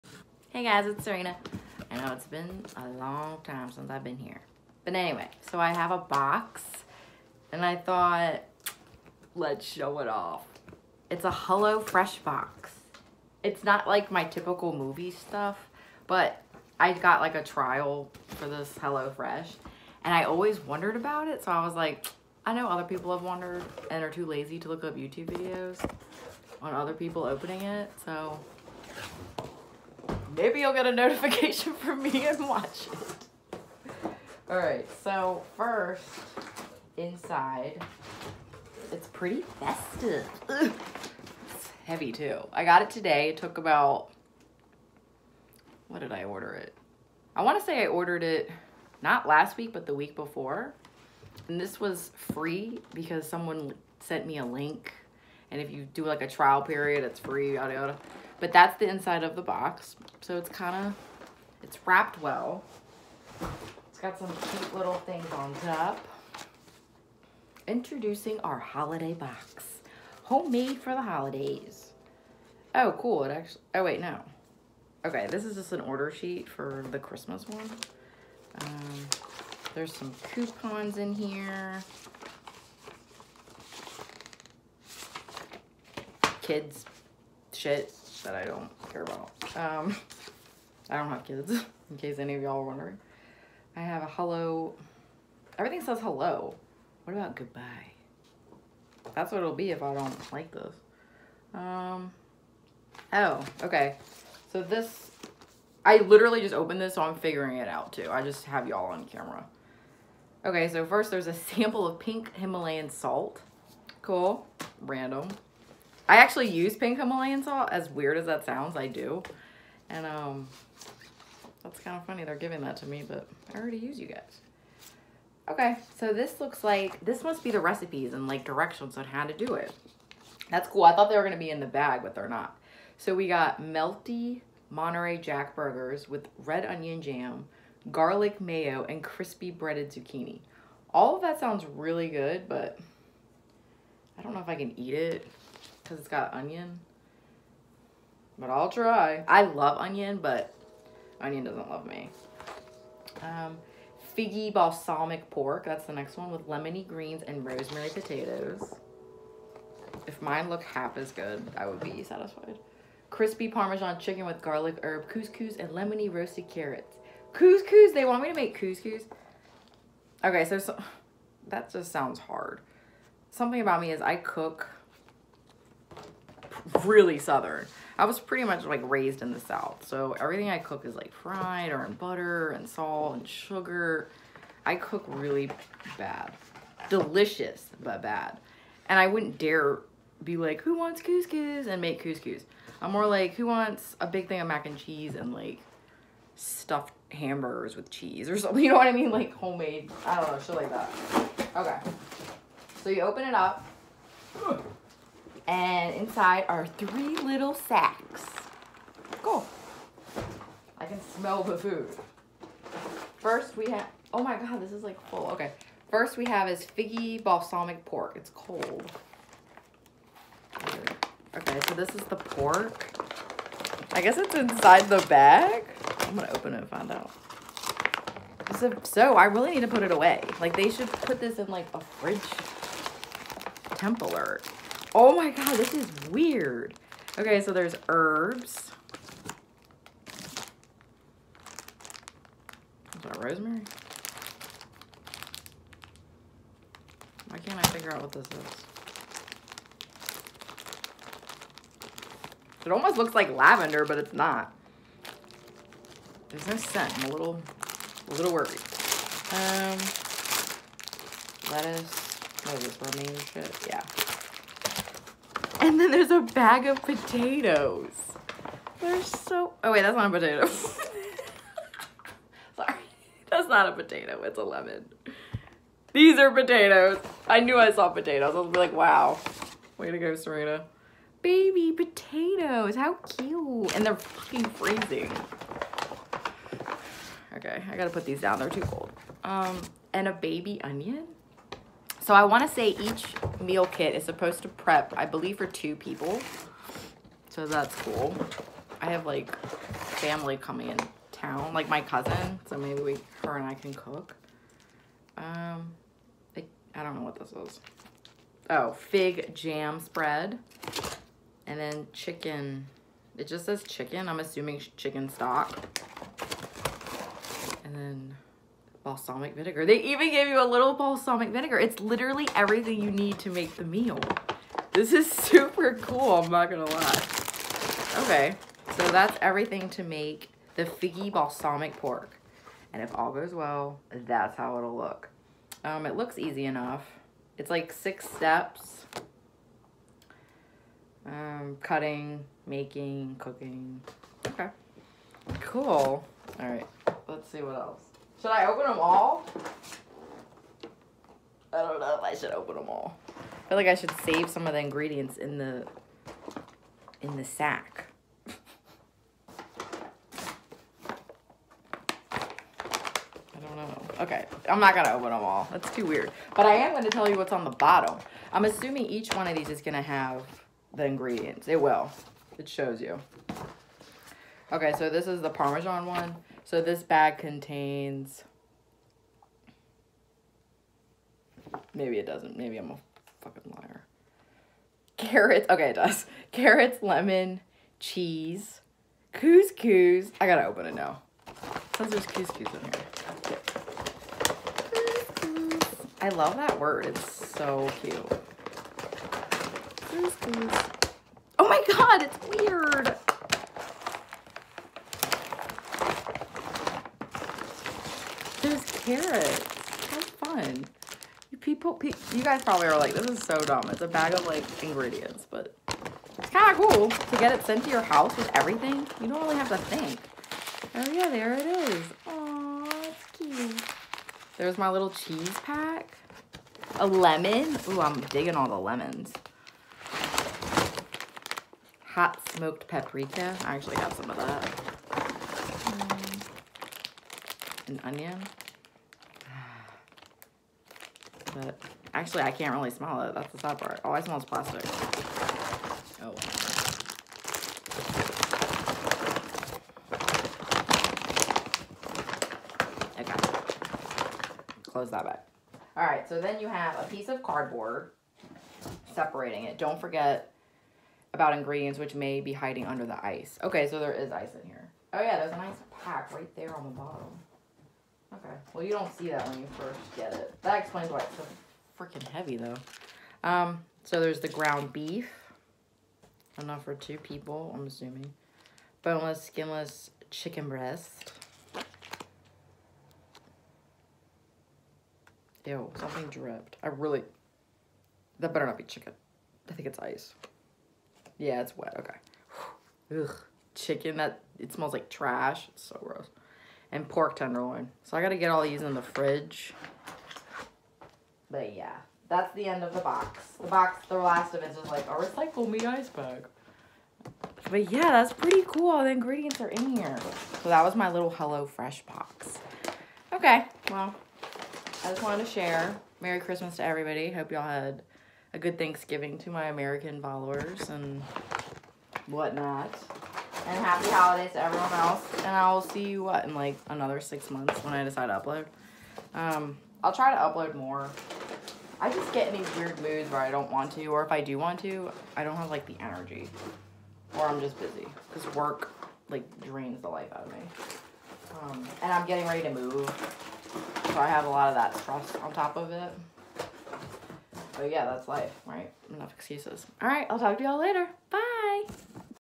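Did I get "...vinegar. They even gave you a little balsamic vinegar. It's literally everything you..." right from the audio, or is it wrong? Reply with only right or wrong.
right.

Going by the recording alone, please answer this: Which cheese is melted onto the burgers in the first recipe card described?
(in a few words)
Monterey Jack.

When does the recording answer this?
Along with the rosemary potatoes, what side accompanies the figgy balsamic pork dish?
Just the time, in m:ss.
2:36.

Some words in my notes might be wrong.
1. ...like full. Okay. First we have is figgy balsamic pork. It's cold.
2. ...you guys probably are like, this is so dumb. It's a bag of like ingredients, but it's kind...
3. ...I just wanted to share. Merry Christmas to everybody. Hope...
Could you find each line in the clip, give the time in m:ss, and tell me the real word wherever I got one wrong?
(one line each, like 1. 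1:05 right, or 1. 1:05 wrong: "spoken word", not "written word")
1. 3:34 right
2. 6:52 right
3. 8:34 right.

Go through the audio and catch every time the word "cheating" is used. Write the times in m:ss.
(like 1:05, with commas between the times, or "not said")
not said.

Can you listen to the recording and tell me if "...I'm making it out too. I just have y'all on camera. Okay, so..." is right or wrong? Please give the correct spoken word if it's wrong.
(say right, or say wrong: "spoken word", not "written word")
wrong: "figuring", not "making".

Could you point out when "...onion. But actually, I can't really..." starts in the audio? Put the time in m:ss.
7:17.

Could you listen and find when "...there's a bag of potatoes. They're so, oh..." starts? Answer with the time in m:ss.
4:25.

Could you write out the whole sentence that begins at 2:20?
All of that sounds really good, but I don't know if I can eat it because it's got onion.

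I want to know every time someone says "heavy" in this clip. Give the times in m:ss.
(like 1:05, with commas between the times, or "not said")
0:41, 7:52.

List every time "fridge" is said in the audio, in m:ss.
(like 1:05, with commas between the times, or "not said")
3:51, 8:18.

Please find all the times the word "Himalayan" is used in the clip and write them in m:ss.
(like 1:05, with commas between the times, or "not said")
1:52, 1:56.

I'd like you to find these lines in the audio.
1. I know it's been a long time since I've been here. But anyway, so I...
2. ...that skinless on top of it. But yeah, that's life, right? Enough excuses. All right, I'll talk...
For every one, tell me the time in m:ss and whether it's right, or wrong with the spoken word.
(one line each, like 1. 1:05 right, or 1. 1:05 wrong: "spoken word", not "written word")
1. 0:01 right
2. 9:04 wrong: "stress", not "skinless".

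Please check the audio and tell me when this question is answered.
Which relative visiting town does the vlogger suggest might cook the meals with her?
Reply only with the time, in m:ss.
5:01.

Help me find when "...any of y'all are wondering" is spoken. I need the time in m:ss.
1:32.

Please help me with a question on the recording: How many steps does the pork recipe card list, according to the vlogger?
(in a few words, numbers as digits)
6.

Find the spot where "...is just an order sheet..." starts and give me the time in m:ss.
1:15.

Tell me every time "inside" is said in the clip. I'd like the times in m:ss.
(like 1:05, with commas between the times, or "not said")
0:36, 0:58, 3:25, 3:44.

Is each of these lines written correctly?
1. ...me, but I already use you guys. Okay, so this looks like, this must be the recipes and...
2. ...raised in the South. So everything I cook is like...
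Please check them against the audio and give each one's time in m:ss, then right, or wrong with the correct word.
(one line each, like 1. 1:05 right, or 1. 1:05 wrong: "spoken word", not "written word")
1. 2:02 right
2. 2:58 right.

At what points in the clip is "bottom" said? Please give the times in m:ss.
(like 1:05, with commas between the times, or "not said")
6:07, 7:46.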